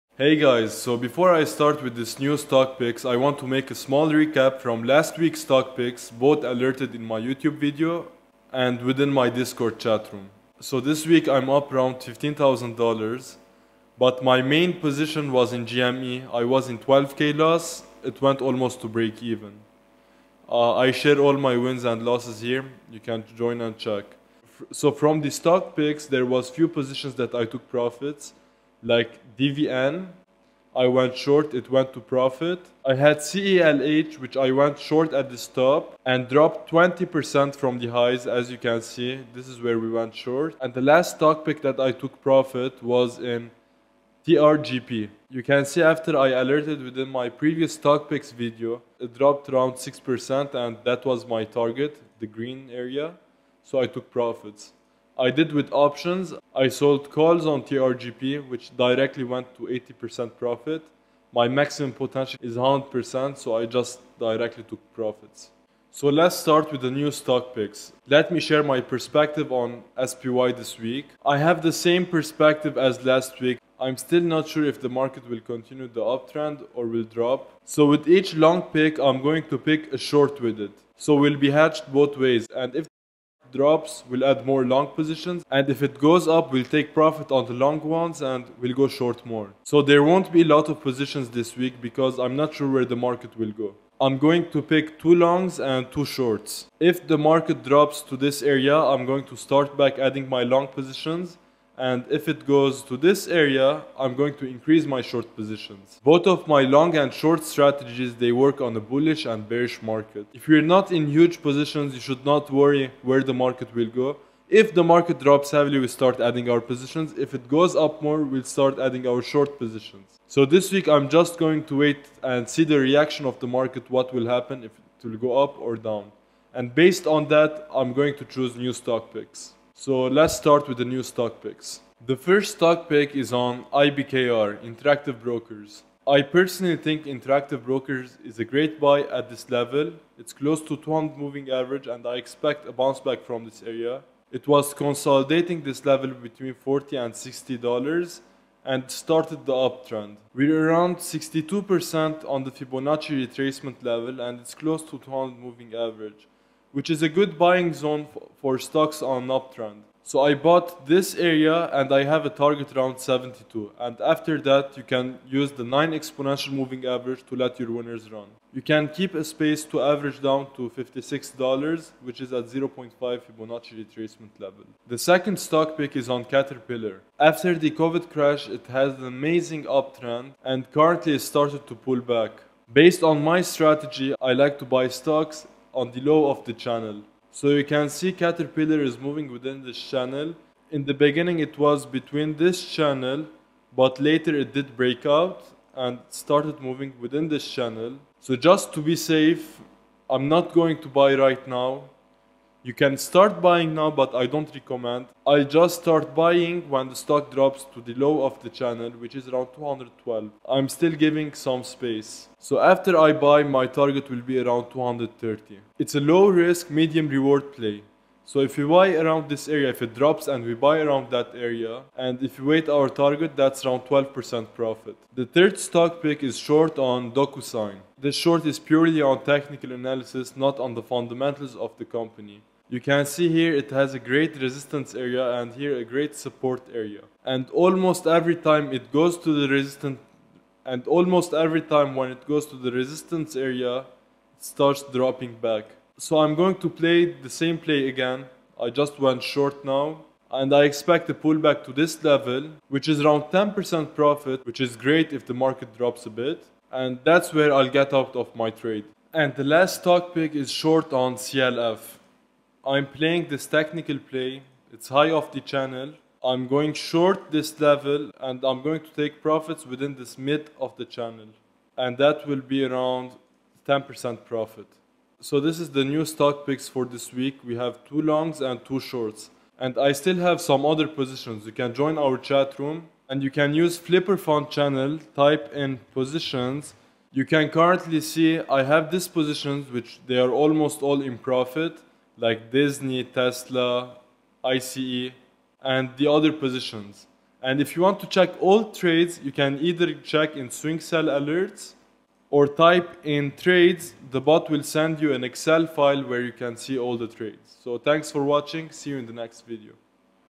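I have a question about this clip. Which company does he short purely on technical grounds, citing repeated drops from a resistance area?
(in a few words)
DocuSign.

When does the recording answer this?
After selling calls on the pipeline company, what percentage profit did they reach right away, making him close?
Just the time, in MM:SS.
00:59.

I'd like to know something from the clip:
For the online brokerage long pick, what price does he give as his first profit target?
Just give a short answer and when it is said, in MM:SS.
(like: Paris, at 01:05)
72, at 02:42.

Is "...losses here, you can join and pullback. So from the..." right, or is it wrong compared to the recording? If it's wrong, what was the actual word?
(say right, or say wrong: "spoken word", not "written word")
wrong: "check", not "pullback".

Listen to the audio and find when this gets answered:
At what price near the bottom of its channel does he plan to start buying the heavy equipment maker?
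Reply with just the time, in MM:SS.
03:29.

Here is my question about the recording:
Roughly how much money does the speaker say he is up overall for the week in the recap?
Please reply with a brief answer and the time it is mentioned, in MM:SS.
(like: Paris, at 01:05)
$15,000, at 00:11.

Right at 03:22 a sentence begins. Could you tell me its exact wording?
You can start buying now, but I don't recommend.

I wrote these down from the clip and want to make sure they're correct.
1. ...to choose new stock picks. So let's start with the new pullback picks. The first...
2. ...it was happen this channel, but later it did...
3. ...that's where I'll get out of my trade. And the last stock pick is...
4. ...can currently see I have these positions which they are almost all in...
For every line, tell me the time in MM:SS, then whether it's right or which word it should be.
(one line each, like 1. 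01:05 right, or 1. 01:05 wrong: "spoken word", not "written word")
1. 02:08 wrong: "stock", not "pullback"
2. 03:11 wrong: "between", not "happen"
3. 04:17 right
4. 04:47 right.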